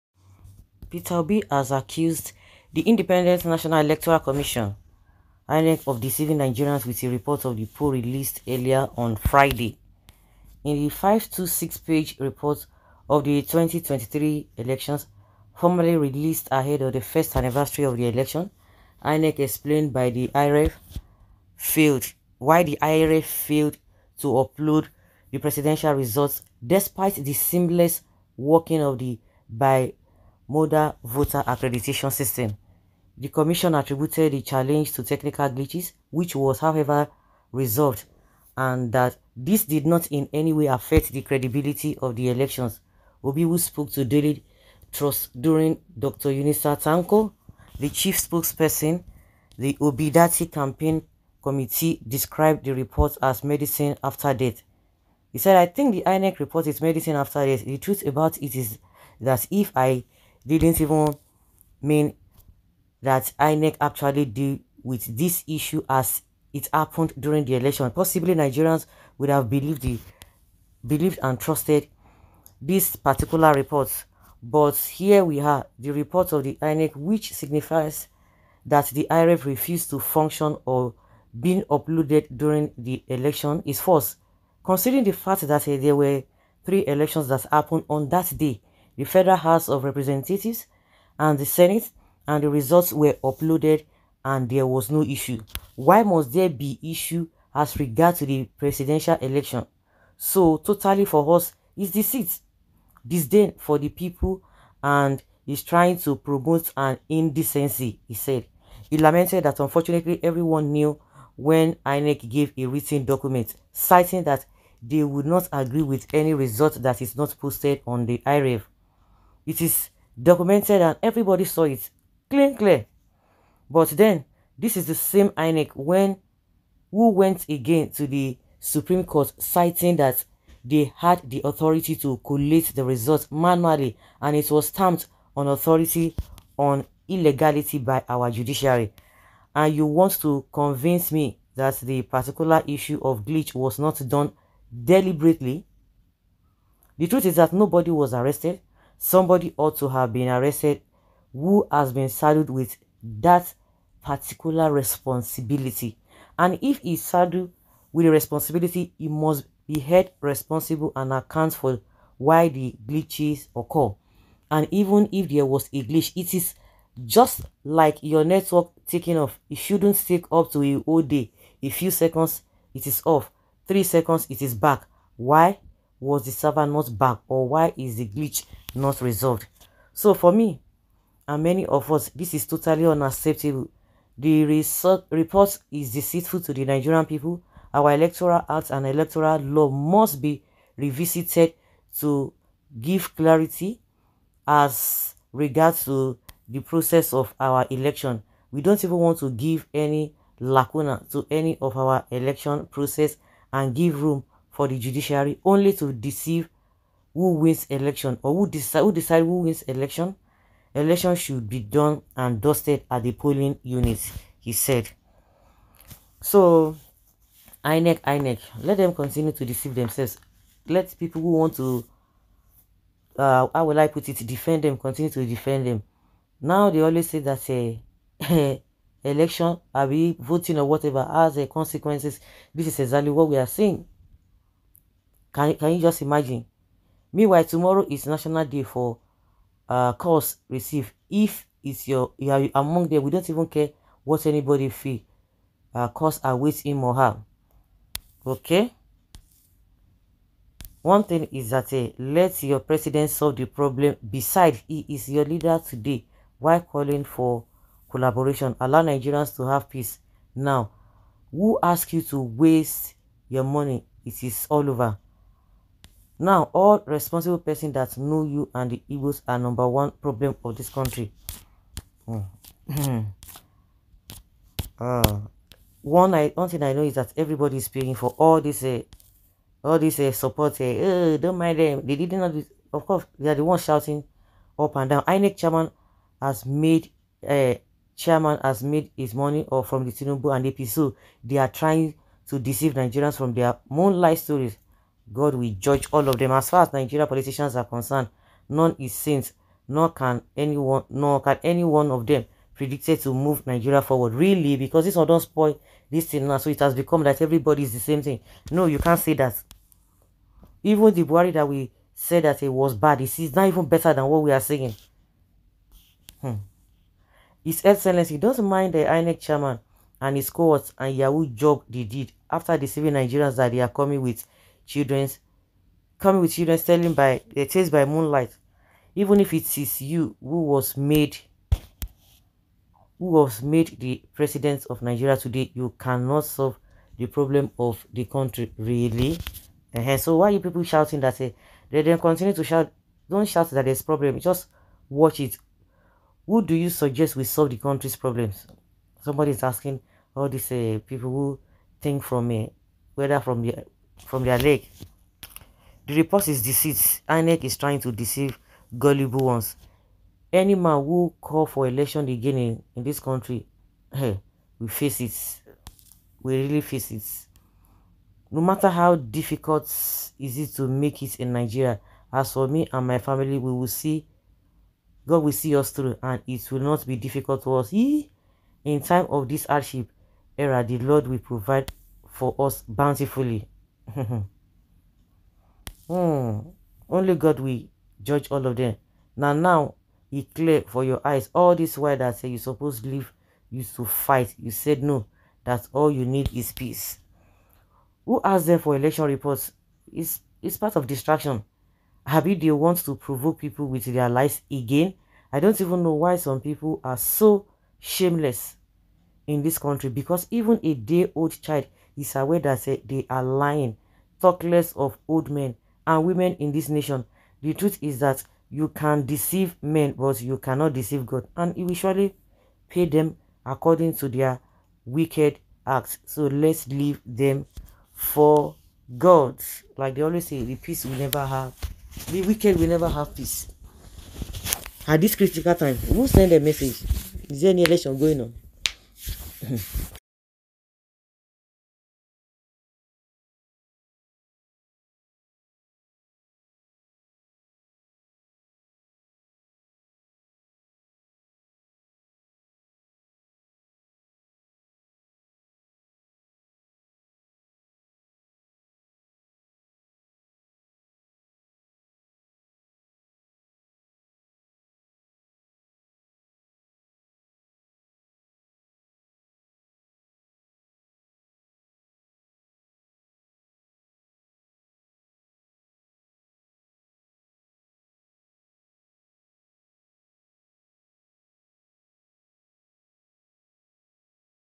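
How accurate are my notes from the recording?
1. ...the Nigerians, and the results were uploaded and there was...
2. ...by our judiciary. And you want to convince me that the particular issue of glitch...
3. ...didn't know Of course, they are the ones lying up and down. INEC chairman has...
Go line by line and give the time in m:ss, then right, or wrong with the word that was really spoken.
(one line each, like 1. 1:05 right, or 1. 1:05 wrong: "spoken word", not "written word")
1. 1:31 wrong: "Senate", not "Nigerians"
2. 2:17 right
3. 4:41 wrong: "shouting", not "lying".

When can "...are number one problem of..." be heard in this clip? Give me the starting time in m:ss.
4:29.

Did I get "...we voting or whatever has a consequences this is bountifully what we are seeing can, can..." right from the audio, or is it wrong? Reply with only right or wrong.
wrong.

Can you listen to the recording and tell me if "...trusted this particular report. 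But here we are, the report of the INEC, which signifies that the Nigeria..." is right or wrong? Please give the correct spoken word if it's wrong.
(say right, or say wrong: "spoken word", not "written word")
wrong: "IREV", not "Nigeria".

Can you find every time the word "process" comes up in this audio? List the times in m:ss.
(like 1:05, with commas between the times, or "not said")
3:16, 3:22.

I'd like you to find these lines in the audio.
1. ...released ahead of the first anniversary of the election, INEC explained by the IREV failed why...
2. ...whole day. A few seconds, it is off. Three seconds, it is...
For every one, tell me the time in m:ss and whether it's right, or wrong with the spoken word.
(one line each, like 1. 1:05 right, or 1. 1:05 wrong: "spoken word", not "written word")
1. 0:15 right
2. 2:50 right.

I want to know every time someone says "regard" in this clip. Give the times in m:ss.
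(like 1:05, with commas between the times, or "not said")
1:37, 3:15.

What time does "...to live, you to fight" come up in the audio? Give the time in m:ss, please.
6:32.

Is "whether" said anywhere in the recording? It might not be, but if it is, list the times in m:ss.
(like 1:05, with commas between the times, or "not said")
5:52.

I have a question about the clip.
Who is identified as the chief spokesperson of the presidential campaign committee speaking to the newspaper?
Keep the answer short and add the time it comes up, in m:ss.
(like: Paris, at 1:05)
Dr. Yunusa Tanko, at 0:45.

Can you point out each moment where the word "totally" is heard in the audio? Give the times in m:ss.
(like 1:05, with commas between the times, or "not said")
1:40, 3:02.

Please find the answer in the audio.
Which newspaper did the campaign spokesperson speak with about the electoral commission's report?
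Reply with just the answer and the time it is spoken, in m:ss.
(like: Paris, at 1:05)
Daily Trust, at 0:44.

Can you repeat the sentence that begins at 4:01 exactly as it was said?
If it's your you are among them, we don't even care what anybody feel.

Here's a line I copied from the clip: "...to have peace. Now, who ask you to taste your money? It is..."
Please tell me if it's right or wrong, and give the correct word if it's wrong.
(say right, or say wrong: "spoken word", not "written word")
wrong: "waste", not "taste".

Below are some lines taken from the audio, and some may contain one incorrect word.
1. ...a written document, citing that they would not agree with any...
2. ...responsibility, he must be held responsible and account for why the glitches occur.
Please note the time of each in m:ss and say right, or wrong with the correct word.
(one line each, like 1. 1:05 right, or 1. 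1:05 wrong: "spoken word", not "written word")
1. 1:52 right
2. 2:38 right.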